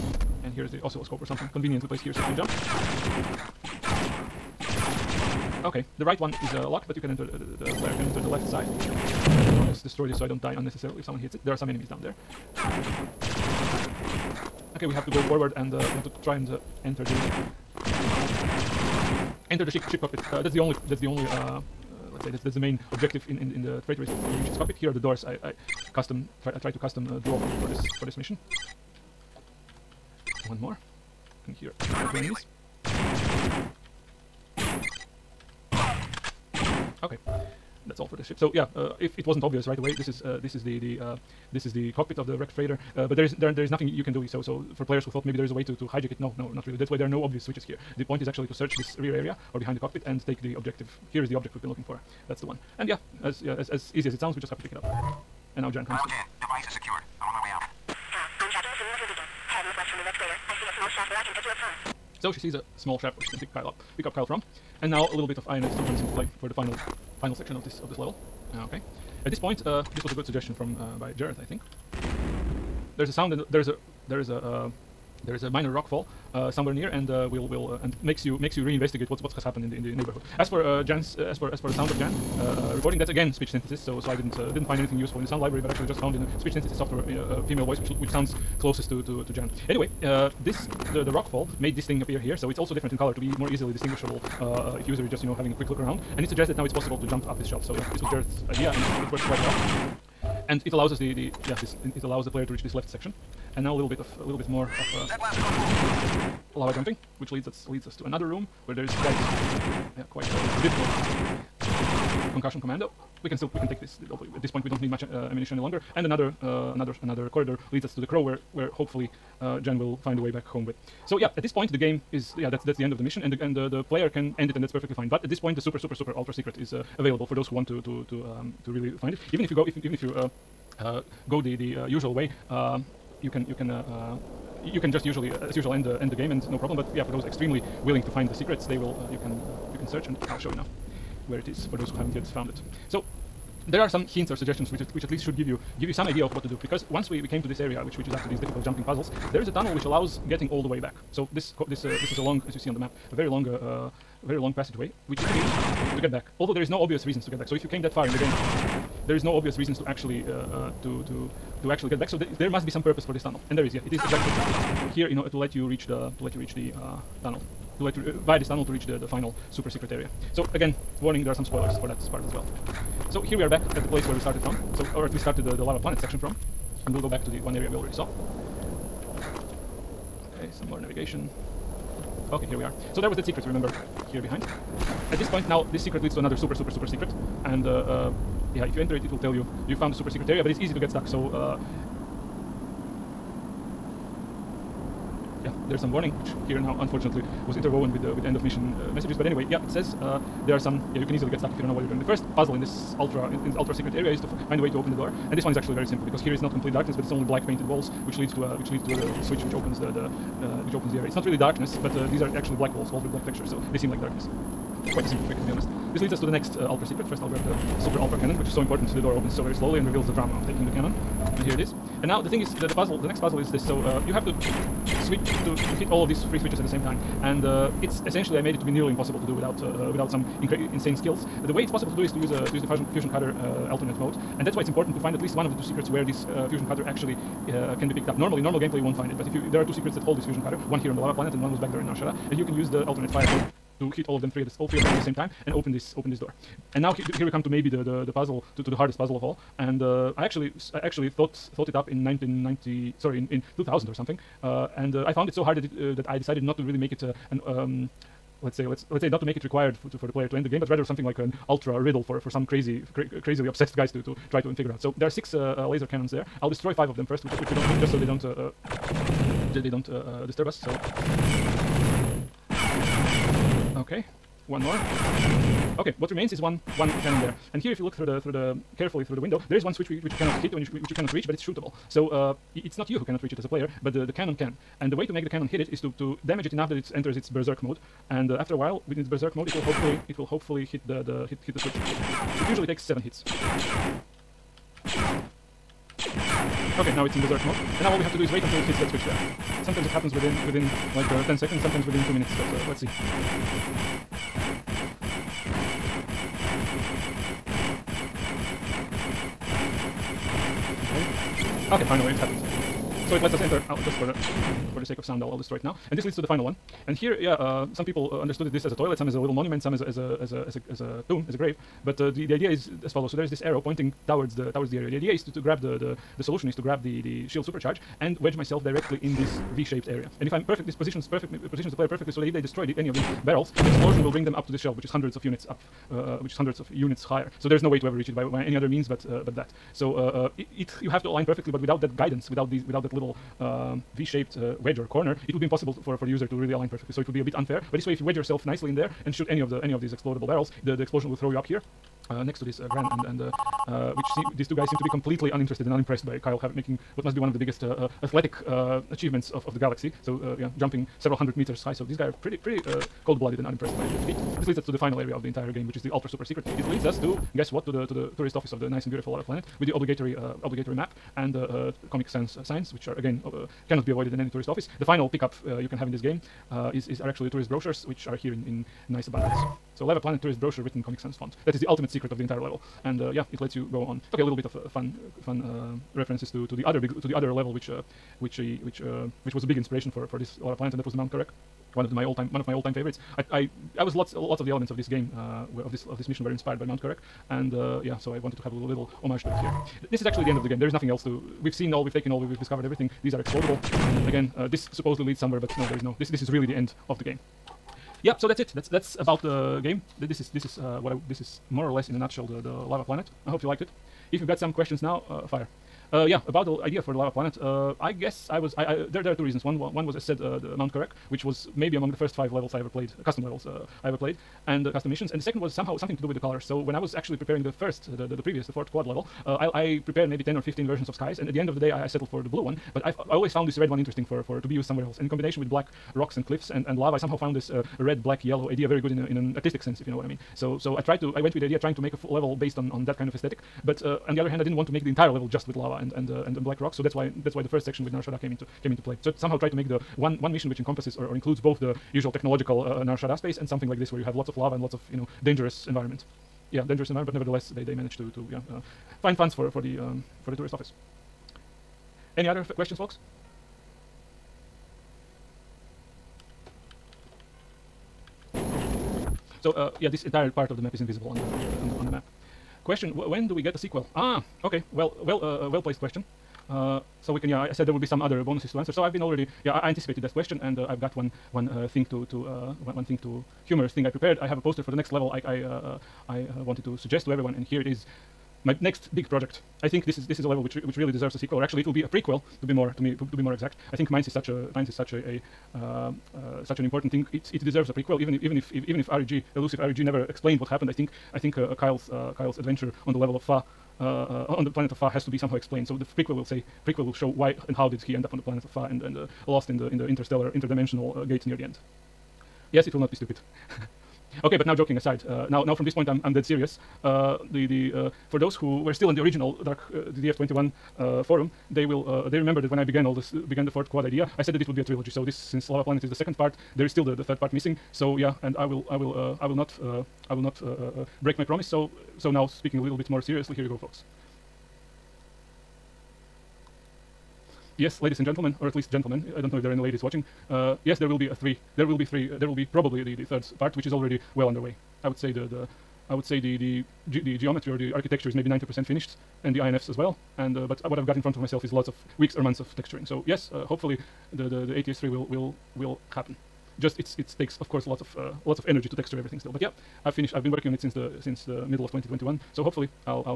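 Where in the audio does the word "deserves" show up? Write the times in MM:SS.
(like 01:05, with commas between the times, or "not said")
08:10, 08:17.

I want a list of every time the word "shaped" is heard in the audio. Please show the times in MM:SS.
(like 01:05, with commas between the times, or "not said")
05:29, 05:43.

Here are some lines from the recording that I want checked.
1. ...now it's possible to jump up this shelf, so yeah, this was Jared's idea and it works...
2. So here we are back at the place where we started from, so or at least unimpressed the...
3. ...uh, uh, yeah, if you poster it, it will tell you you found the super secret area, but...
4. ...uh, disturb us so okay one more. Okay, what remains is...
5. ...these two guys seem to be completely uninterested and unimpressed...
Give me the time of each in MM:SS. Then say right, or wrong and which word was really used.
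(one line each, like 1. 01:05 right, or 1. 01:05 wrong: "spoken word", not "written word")
1. 01:36 right
2. 02:53 wrong: "started", not "unimpressed"
3. 03:07 wrong: "enter", not "poster"
4. 04:29 right
5. 05:54 right.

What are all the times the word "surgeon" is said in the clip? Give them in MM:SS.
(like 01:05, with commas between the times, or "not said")
not said.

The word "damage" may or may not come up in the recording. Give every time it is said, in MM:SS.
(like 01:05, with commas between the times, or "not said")
04:46.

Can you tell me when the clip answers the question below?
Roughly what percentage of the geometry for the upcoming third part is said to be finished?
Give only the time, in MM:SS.
09:08.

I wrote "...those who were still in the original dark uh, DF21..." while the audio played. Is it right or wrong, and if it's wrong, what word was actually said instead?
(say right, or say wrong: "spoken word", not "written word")
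right.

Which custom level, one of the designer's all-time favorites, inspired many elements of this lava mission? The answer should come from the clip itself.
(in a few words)
Mount Karak.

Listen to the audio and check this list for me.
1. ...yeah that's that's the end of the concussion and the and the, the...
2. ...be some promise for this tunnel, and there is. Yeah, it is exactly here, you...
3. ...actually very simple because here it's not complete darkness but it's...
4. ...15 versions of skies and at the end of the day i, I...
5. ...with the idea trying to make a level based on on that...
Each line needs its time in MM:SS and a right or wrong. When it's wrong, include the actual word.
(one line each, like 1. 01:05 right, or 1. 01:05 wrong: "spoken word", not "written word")
1. 02:02 wrong: "mission", not "concussion"
2. 02:42 wrong: "purpose", not "promise"
3. 03:25 right
4. 07:10 right
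5. 07:21 right.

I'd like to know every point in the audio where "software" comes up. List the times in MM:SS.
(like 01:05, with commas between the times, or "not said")
01:26.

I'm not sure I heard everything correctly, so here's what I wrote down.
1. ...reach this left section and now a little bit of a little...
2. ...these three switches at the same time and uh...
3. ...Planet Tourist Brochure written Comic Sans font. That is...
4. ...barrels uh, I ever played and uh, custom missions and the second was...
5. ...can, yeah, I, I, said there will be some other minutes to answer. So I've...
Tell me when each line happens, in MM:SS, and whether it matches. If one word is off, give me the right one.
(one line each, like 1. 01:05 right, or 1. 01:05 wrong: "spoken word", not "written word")
1. 01:42 right
2. 03:46 right
3. 06:19 right
4. 07:03 wrong: "levels", not "barrels"
5. 07:57 wrong: "bonuses", not "minutes".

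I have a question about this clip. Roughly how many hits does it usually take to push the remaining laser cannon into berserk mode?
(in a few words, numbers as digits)
7.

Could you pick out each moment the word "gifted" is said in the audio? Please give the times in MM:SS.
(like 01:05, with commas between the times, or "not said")
not said.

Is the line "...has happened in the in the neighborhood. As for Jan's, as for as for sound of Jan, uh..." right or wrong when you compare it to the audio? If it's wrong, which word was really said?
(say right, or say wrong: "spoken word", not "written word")
right.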